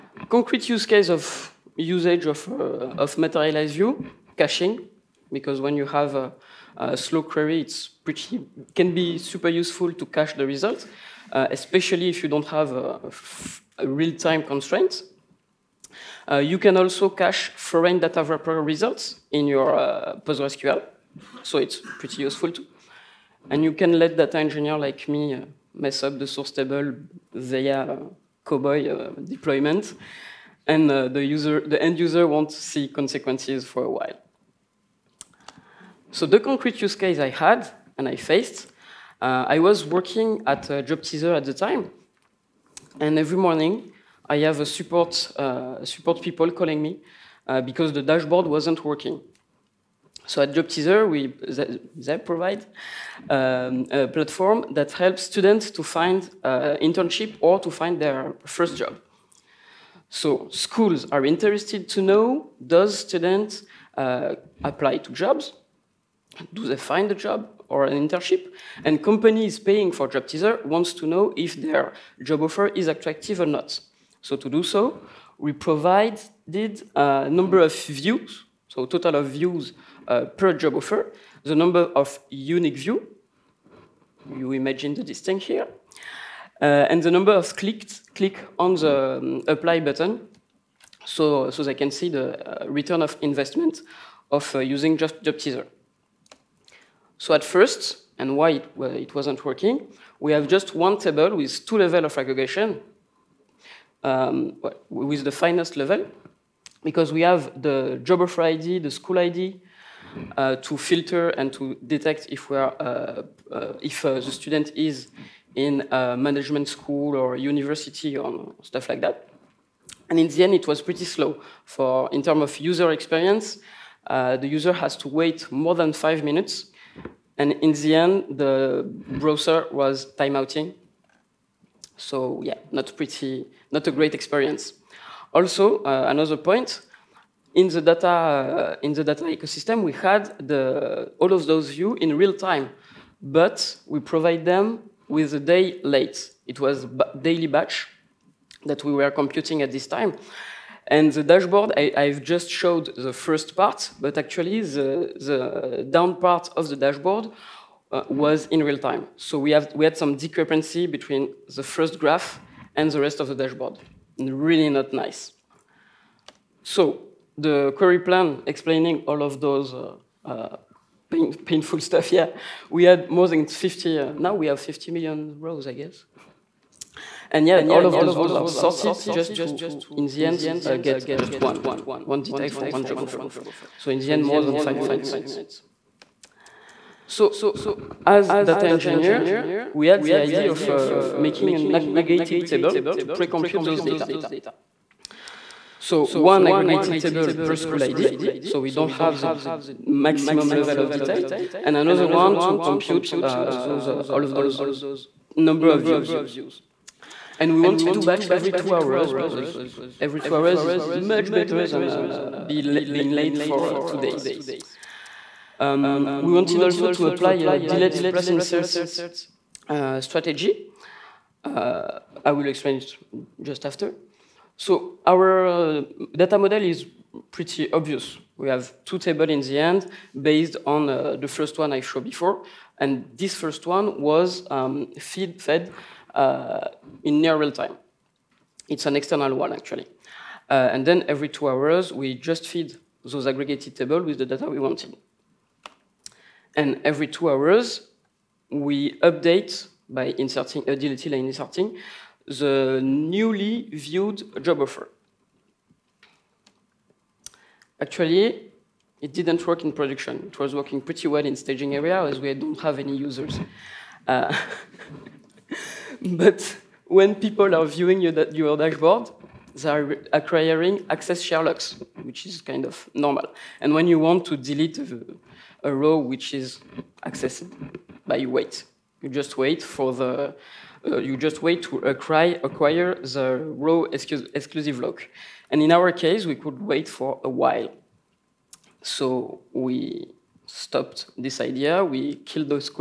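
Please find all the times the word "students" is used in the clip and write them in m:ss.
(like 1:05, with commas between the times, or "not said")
0:55, 1:02, 1:54.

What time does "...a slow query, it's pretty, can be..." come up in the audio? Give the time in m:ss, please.
0:06.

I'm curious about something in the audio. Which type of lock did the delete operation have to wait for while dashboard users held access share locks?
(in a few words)
row exclusive lock.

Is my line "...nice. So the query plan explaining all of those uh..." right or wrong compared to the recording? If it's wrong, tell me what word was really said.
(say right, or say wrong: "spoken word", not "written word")
right.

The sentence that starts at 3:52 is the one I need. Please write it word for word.
And this first one was um, feed fed in near real time.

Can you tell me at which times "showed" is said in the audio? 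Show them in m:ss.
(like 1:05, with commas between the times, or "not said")
2:32, 3:51.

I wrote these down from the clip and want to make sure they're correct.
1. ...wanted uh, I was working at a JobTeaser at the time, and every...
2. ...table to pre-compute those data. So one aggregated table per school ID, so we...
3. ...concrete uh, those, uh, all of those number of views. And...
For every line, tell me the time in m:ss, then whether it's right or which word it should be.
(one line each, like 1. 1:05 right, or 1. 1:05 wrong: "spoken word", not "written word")
1. 0:38 wrong: "faced", not "wanted"
2. 3:12 right
3. 3:22 wrong: "compute", not "concrete".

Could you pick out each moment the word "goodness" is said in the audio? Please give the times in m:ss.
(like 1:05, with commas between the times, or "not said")
not said.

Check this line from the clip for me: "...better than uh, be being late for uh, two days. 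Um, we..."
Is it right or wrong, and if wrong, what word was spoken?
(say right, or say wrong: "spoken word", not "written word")
right.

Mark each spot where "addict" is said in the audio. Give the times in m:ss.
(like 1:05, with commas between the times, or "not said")
not said.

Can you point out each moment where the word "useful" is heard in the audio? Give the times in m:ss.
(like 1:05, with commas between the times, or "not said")
0:09, 0:22.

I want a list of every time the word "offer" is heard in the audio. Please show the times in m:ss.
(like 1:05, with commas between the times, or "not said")
1:12, 1:20, 1:48, 3:03, 4:14.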